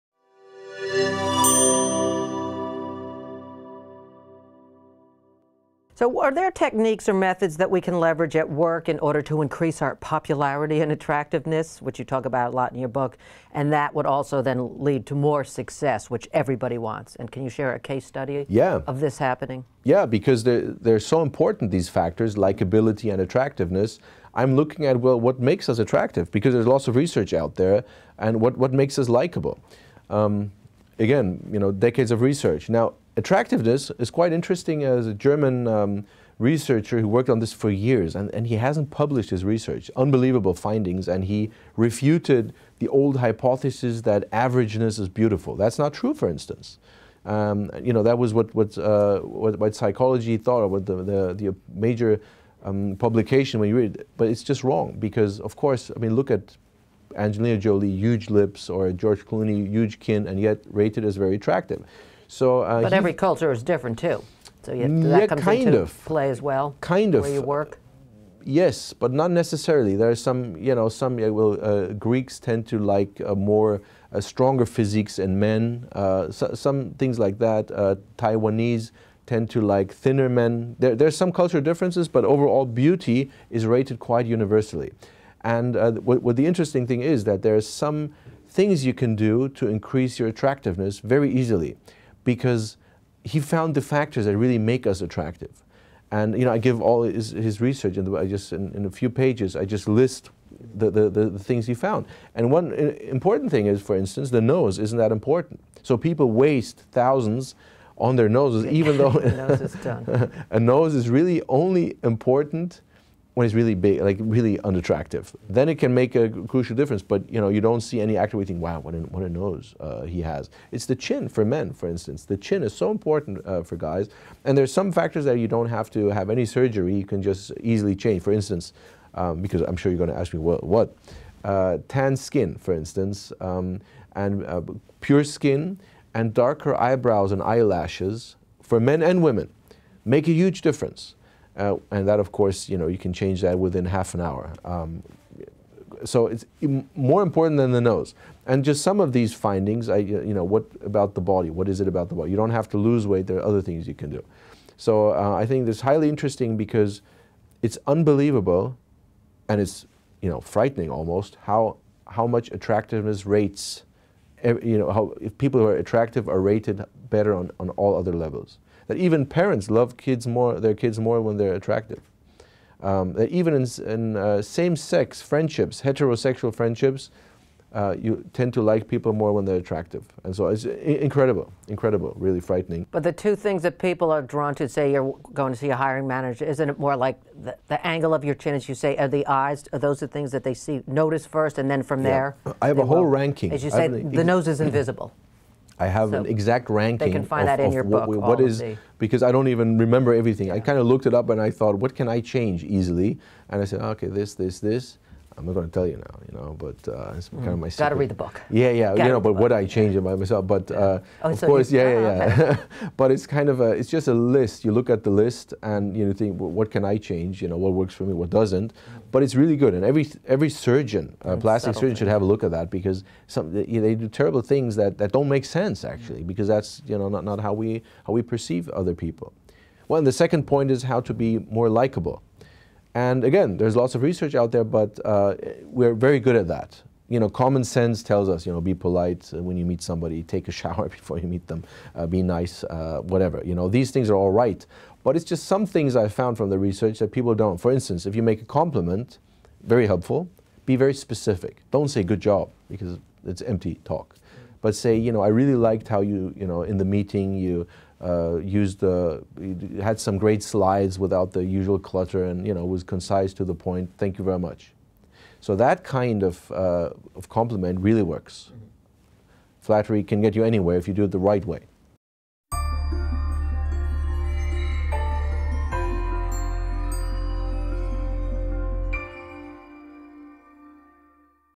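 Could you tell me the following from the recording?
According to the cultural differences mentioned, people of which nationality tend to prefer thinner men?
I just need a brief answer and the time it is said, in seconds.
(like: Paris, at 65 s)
Taiwanese, at 78 s.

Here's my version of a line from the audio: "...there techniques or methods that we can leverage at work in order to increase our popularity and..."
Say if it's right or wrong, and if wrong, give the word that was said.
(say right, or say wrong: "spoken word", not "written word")
right.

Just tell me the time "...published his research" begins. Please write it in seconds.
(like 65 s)
38 s.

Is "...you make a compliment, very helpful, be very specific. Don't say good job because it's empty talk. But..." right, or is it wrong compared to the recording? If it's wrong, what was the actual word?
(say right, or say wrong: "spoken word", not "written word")
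right.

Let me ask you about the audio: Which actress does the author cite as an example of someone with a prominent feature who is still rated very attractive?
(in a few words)
Angelina Jolie.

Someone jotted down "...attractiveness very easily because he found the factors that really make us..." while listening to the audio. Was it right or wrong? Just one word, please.
right.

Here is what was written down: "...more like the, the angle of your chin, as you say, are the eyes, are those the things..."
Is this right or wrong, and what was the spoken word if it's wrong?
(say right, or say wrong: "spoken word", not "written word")
right.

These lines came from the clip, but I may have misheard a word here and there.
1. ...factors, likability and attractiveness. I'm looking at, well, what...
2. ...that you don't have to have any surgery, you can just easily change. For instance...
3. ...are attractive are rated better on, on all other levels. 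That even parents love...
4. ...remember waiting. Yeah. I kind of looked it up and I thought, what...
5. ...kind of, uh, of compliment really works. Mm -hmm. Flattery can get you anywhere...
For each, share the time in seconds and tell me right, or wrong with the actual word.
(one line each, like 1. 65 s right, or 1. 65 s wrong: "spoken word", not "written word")
1. 21 s right
2. 125 s right
3. 165 s right
4. 199 s wrong: "everything", not "waiting"
5. 265 s right.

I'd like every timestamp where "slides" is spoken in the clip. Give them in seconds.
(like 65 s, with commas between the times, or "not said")
260 s.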